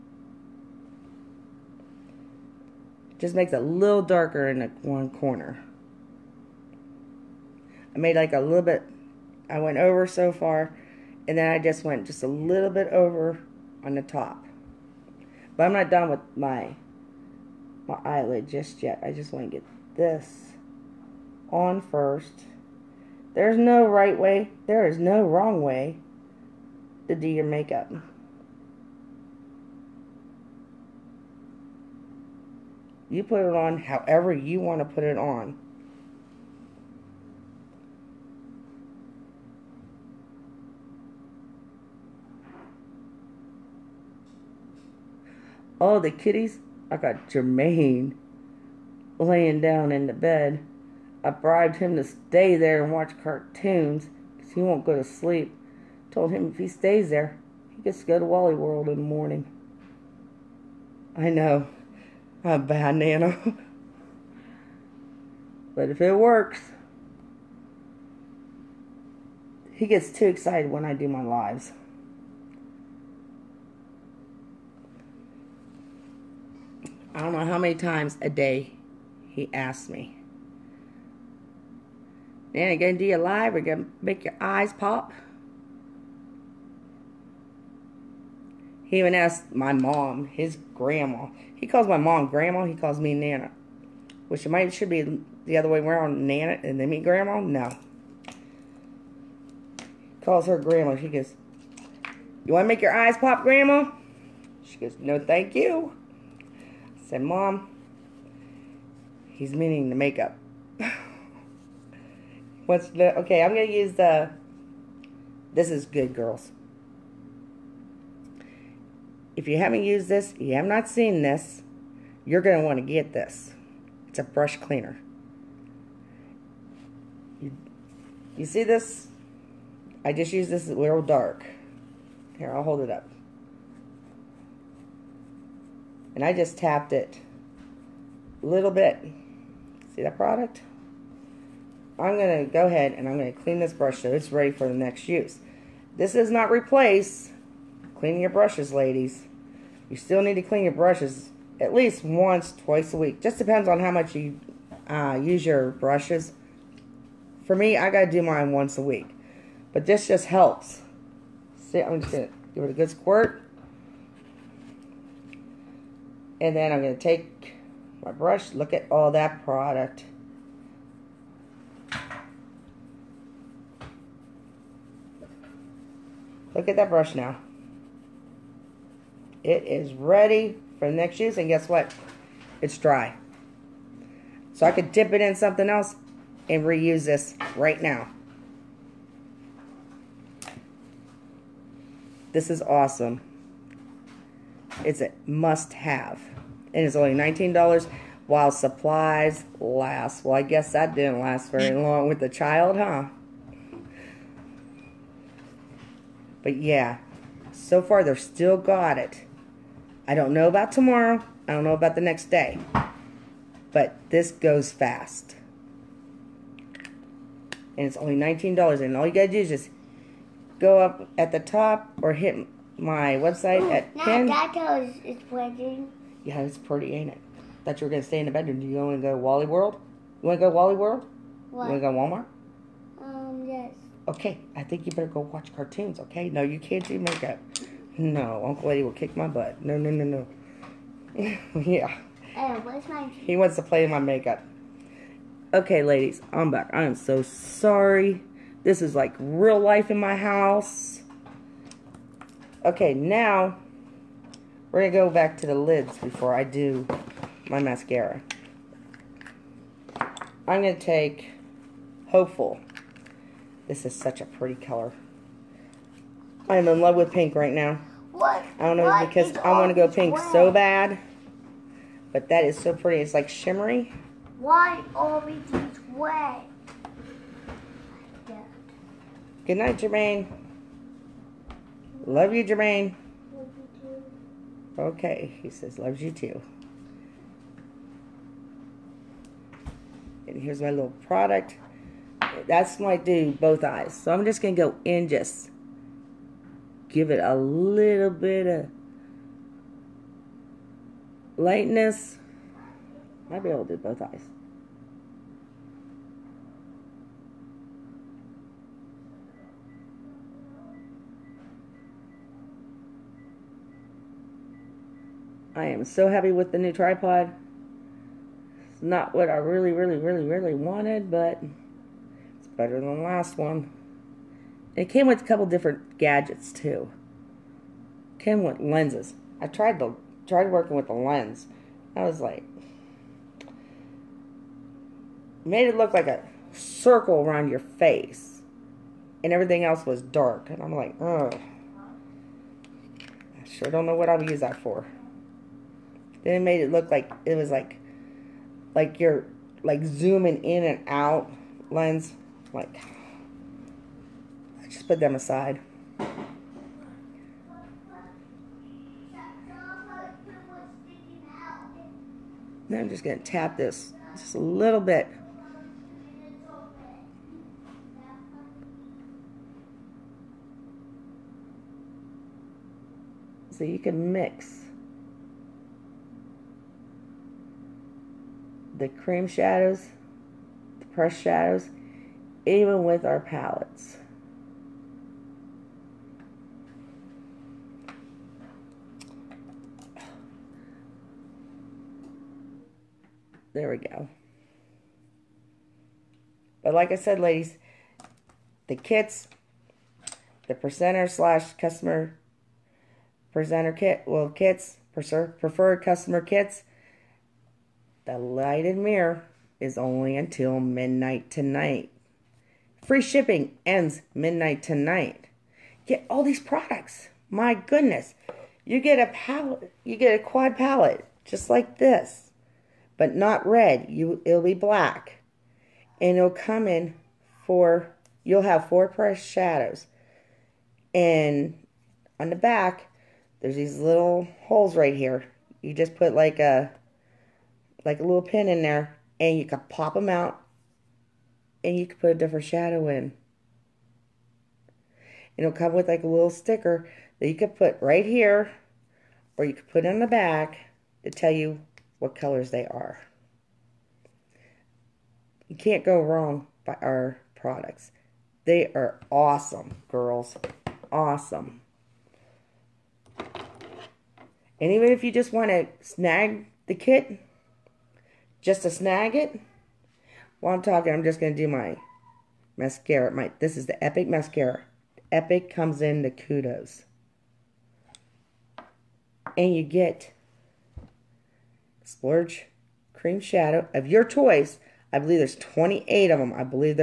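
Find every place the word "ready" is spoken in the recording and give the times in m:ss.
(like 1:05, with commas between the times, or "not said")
2:24, 2:59.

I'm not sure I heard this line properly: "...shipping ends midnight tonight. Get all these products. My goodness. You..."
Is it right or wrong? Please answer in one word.
right.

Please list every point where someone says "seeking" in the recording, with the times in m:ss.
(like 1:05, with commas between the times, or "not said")
not said.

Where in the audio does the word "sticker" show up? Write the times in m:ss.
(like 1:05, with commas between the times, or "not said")
7:26.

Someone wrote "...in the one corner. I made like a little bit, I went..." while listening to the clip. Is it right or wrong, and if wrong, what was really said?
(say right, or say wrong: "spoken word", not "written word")
right.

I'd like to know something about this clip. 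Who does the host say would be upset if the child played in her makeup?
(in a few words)
Uncle Eddie.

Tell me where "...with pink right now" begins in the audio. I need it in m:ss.
4:26.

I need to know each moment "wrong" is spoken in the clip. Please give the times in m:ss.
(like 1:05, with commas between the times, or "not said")
0:25, 7:36.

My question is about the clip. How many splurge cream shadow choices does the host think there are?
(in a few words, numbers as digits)
28.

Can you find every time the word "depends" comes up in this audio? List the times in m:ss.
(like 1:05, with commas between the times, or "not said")
2:33.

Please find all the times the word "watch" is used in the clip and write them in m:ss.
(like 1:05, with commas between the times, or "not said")
0:52, 3:55.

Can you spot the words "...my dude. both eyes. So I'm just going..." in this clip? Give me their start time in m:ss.
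4:52.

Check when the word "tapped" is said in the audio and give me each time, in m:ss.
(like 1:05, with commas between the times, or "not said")
2:16.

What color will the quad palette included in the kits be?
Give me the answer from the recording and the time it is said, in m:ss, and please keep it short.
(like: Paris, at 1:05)
black, at 7:04.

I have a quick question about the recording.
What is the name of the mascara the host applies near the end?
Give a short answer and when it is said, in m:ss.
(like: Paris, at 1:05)
Epic Mascara, at 7:53.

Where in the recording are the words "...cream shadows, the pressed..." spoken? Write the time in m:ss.
6:18.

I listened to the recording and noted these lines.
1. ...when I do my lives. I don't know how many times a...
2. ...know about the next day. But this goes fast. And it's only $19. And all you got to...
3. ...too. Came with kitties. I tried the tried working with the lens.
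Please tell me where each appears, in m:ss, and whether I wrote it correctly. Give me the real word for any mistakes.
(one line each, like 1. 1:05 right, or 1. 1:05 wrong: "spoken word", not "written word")
1. 1:10 right
2. 3:31 right
3. 5:26 wrong: "lenses", not "kitties".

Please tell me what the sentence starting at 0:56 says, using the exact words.
Told him if he stays there, he gets to go to Wally World in the morning.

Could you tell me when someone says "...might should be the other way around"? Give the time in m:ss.
1:34.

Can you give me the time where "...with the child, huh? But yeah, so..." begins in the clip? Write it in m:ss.
3:22.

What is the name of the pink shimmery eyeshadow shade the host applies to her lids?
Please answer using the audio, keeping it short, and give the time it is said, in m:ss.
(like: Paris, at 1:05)
Hopeful, at 4:22.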